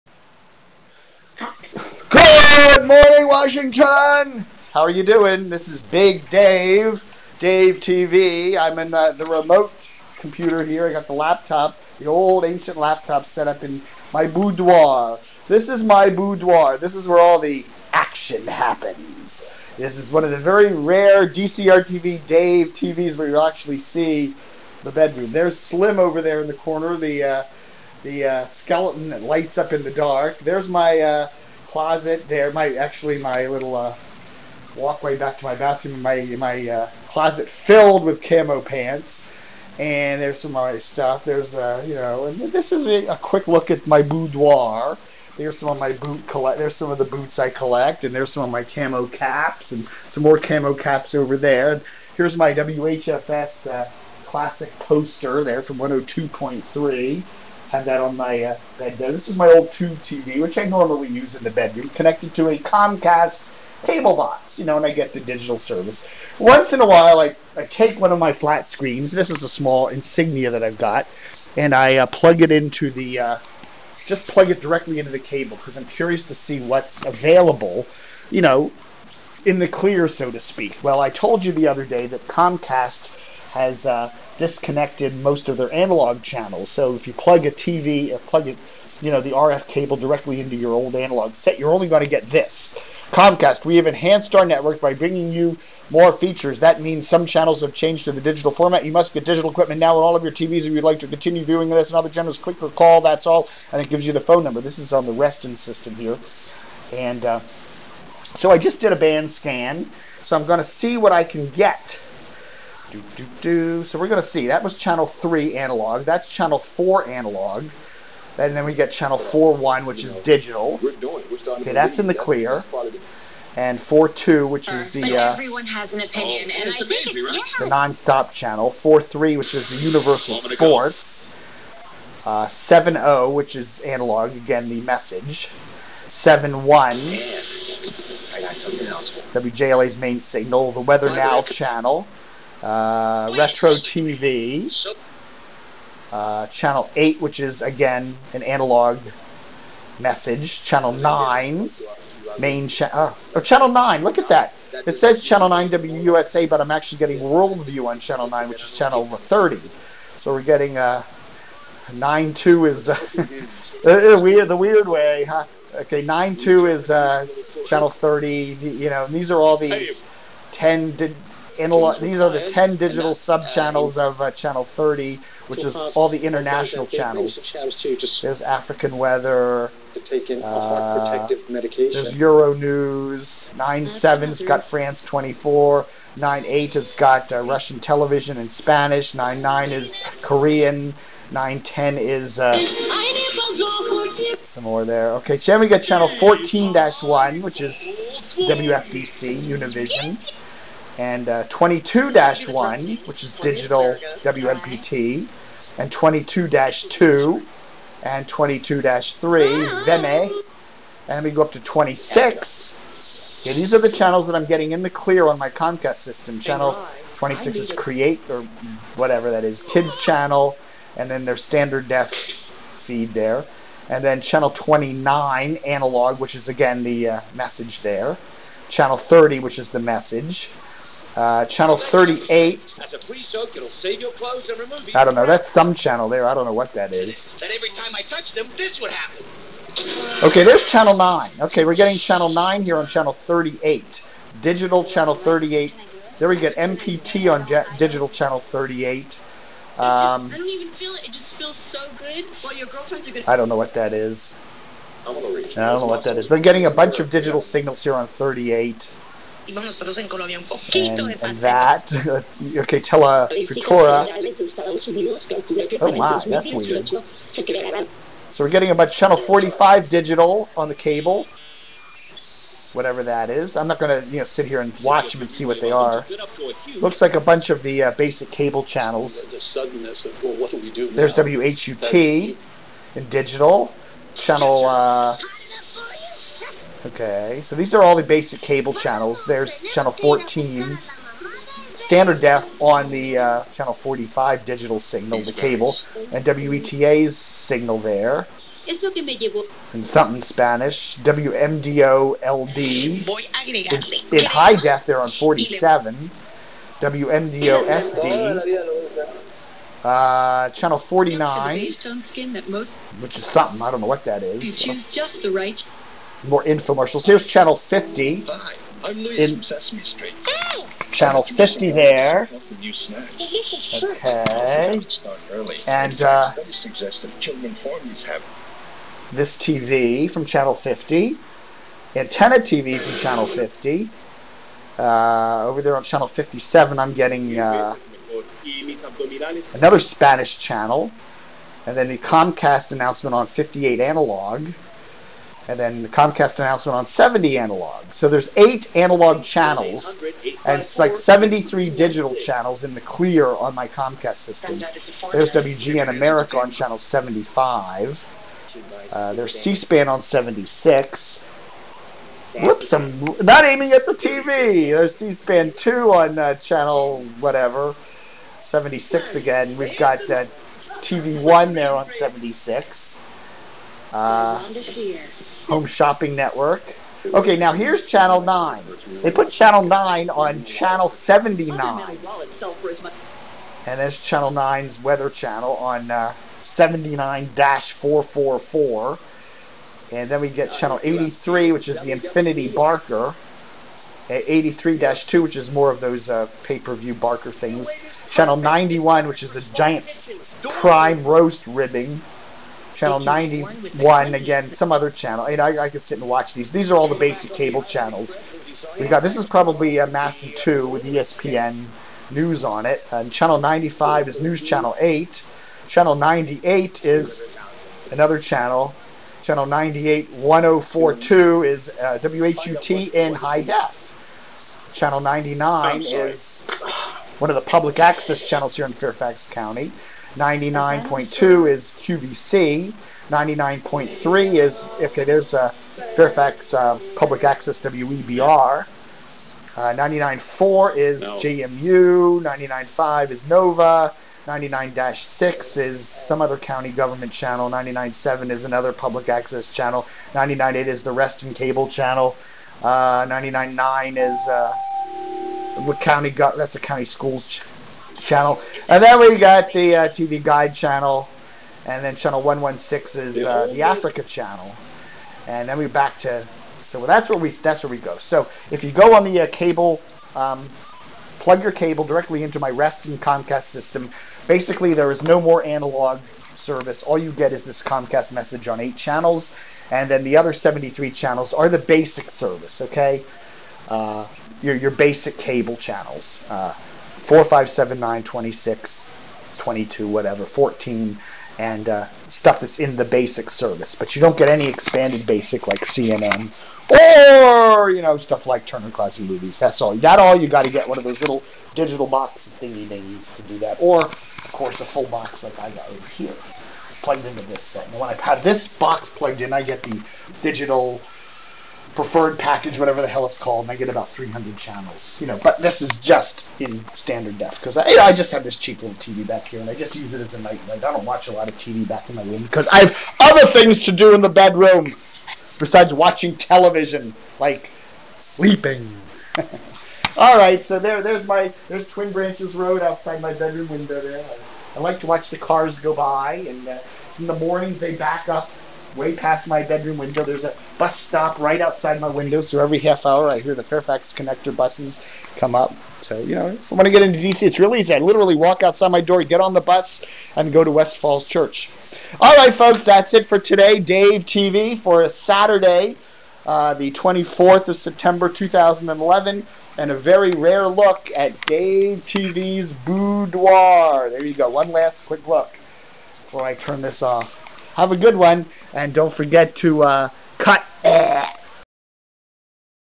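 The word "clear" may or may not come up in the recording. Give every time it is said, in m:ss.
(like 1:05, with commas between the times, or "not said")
1:19, 2:02, 3:34, 5:52.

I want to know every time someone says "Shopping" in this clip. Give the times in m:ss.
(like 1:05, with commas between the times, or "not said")
6:15.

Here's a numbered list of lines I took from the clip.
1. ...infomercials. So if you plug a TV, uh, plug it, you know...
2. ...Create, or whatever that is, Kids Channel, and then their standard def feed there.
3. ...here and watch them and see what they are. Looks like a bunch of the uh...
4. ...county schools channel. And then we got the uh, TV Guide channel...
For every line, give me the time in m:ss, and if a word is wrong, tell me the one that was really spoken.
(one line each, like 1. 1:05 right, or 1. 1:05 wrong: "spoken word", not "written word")
1. 1:26 wrong: "channels", not "infomercials"
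2. 3:37 right
3. 4:34 right
4. 7:36 right.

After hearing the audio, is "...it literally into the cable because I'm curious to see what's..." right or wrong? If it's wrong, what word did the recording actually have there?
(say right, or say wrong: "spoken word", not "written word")
wrong: "directly", not "literally".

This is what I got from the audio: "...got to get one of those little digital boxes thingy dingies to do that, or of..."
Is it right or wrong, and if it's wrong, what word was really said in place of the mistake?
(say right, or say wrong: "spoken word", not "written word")
right.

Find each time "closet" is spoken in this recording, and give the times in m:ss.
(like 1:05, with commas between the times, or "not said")
0:31, 0:37.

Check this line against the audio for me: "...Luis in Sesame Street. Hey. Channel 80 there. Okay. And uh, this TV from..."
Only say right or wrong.
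wrong.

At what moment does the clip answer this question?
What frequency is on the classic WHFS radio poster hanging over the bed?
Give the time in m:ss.
0:55.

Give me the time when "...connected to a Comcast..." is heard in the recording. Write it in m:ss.
1:01.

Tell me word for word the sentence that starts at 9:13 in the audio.
Dave TV for a Saturday, uh, the 24th of September 2011, and a very rare look at Dave TV's boudoir.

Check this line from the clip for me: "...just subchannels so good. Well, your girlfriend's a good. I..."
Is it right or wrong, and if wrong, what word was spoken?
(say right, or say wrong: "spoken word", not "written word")
wrong: "feels", not "subchannels".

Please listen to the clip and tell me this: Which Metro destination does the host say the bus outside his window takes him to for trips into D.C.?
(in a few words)
West Falls Church.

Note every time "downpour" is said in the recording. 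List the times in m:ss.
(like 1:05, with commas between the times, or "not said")
not said.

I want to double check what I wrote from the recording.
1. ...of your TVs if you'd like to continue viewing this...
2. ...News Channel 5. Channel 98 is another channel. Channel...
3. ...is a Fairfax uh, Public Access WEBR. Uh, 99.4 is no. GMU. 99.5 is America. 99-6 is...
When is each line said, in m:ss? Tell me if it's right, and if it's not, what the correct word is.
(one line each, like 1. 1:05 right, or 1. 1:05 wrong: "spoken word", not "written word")
1. 1:40 right
2. 6:54 wrong: "8", not "5"
3. 7:15 wrong: "NOVA", not "America".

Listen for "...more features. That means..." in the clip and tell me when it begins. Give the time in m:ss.
1:35.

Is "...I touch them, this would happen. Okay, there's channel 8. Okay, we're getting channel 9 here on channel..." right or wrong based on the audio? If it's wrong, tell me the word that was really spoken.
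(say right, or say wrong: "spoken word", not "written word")
wrong: "9", not "8".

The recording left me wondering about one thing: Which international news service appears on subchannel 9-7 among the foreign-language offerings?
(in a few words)
France 24.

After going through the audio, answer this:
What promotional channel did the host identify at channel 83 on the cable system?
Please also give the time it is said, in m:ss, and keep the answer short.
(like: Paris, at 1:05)
Xfinity Barker, at 6:31.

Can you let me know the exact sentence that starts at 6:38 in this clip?
Channel 91, which is a giant prime roast ribbing channel 91 again, some other channel.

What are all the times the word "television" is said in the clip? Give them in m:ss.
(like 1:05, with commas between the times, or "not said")
3:07, 8:46.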